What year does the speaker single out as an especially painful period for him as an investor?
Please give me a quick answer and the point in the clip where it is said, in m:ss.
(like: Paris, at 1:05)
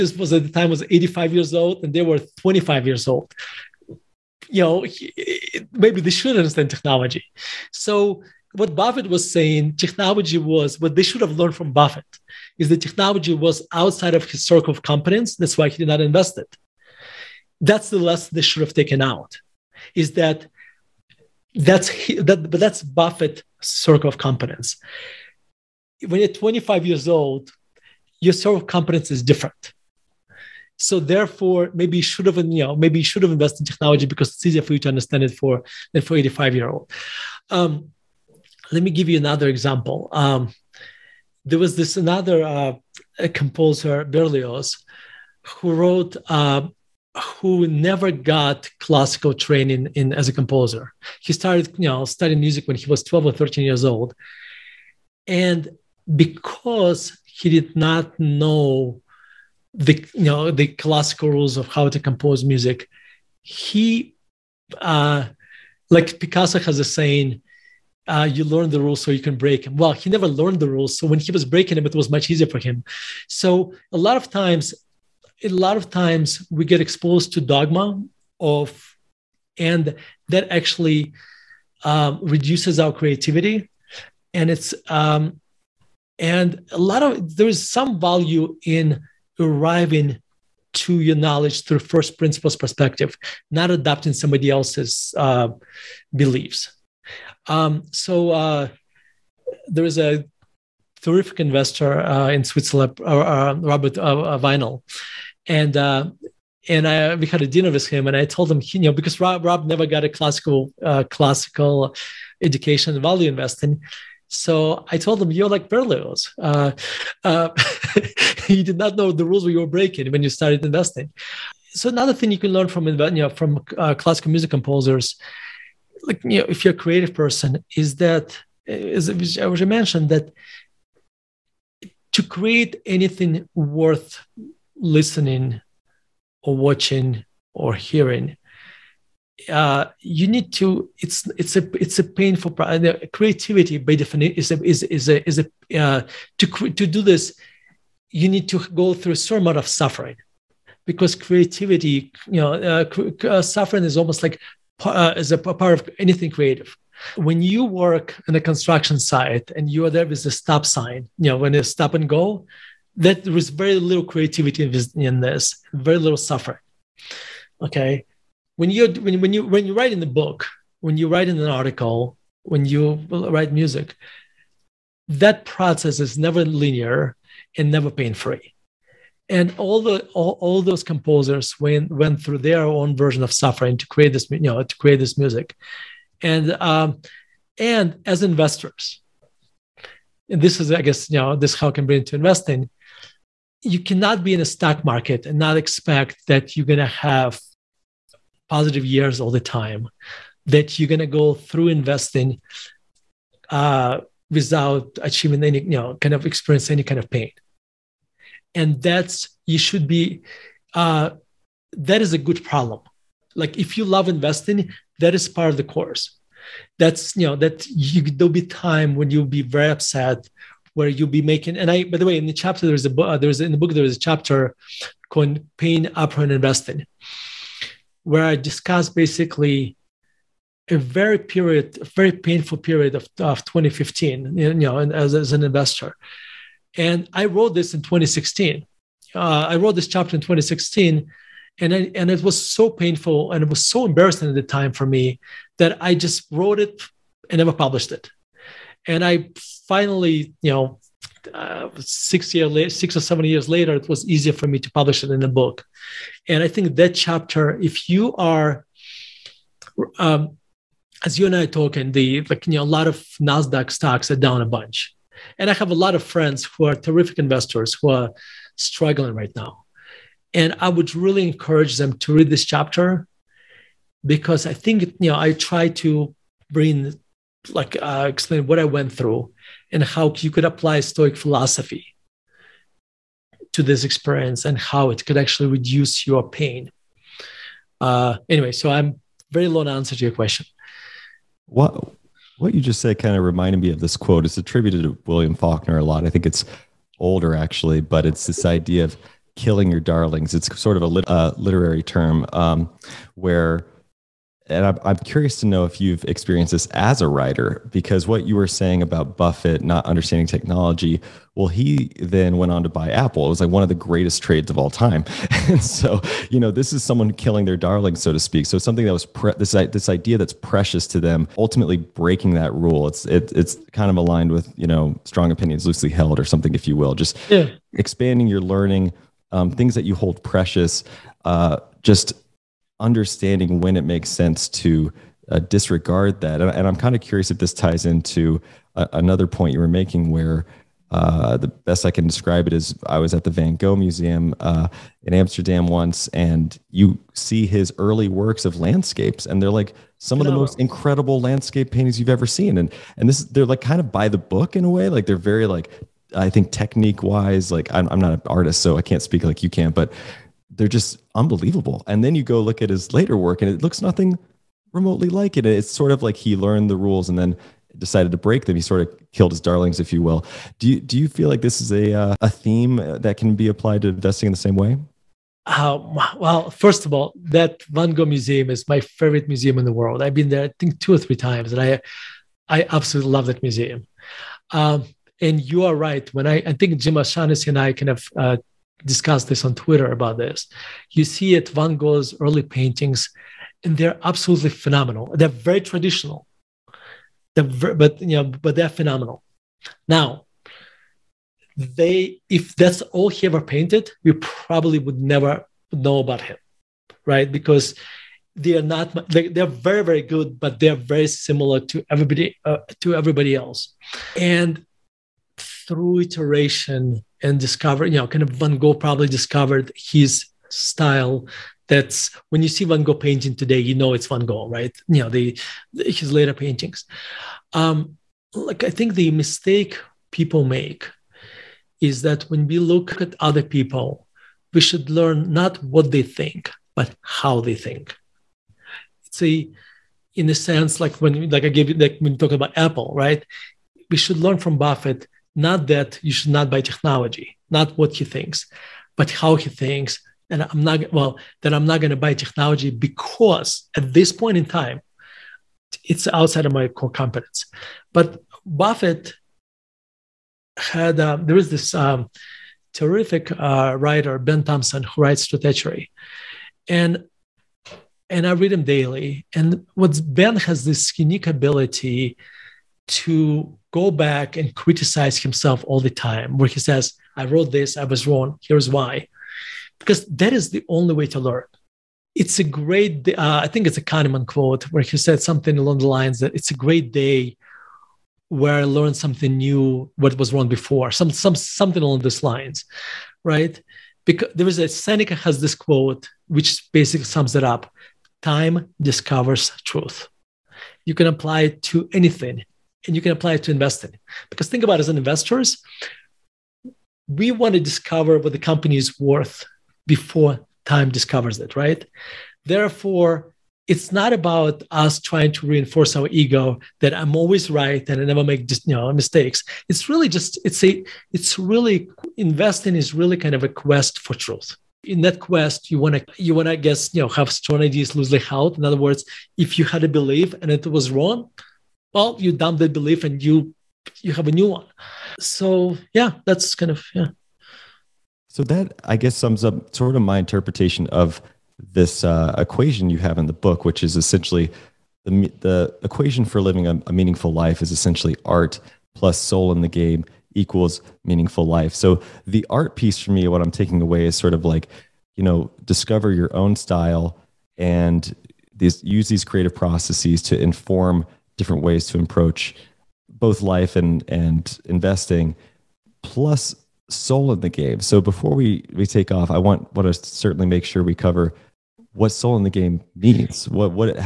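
2015, at 3:53.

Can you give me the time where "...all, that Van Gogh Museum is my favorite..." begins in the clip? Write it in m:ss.
6:16.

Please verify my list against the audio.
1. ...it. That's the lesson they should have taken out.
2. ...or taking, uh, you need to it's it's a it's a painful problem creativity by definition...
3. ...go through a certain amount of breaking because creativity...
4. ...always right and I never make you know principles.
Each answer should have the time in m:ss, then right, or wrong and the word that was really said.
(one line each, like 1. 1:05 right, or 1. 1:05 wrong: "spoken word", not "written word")
1. 0:16 right
2. 2:17 wrong: "hearing", not "taking"
3. 2:28 wrong: "suffering", not "breaking"
4. 8:37 wrong: "mistakes", not "principles".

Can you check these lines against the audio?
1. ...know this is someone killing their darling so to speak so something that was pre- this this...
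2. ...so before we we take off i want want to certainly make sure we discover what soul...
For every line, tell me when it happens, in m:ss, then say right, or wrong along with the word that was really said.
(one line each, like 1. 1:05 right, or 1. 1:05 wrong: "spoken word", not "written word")
1. 5:16 right
2. 9:27 wrong: "cover", not "discover".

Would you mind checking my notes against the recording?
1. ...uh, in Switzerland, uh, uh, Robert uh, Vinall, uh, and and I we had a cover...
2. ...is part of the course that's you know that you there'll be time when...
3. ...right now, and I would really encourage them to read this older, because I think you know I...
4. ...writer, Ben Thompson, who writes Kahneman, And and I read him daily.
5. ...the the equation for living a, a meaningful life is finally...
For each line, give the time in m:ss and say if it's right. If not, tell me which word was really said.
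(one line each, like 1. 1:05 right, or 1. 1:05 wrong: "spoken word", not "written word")
1. 1:42 wrong: "dinner", not "cover"
2. 3:35 right
3. 4:29 wrong: "chapter", not "older"
4. 7:43 wrong: "Stratechery", not "Kahneman"
5. 9:05 wrong: "essentially", not "finally".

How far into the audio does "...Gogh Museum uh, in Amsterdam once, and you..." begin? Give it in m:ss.
5:43.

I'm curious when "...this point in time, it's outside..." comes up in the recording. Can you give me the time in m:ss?
7:33.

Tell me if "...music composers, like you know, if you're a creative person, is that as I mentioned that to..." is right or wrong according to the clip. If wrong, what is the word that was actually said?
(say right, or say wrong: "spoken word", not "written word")
right.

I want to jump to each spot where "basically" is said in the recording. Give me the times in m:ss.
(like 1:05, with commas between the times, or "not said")
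3:48, 8:16.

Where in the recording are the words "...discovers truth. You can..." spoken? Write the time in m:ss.
8:18.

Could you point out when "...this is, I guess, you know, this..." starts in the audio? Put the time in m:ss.
3:10.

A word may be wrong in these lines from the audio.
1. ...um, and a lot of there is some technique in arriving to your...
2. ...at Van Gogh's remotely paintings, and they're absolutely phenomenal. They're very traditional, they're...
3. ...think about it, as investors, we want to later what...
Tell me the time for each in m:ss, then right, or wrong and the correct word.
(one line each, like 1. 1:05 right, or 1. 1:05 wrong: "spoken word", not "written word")
1. 1:24 wrong: "value", not "technique"
2. 6:31 wrong: "early", not "remotely"
3. 8:24 wrong: "discover", not "later".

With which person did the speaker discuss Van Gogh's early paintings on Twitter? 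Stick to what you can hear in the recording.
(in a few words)
Jim O'Shaughnessy.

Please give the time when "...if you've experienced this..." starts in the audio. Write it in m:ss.
5:05.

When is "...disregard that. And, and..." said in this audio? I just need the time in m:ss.
5:35.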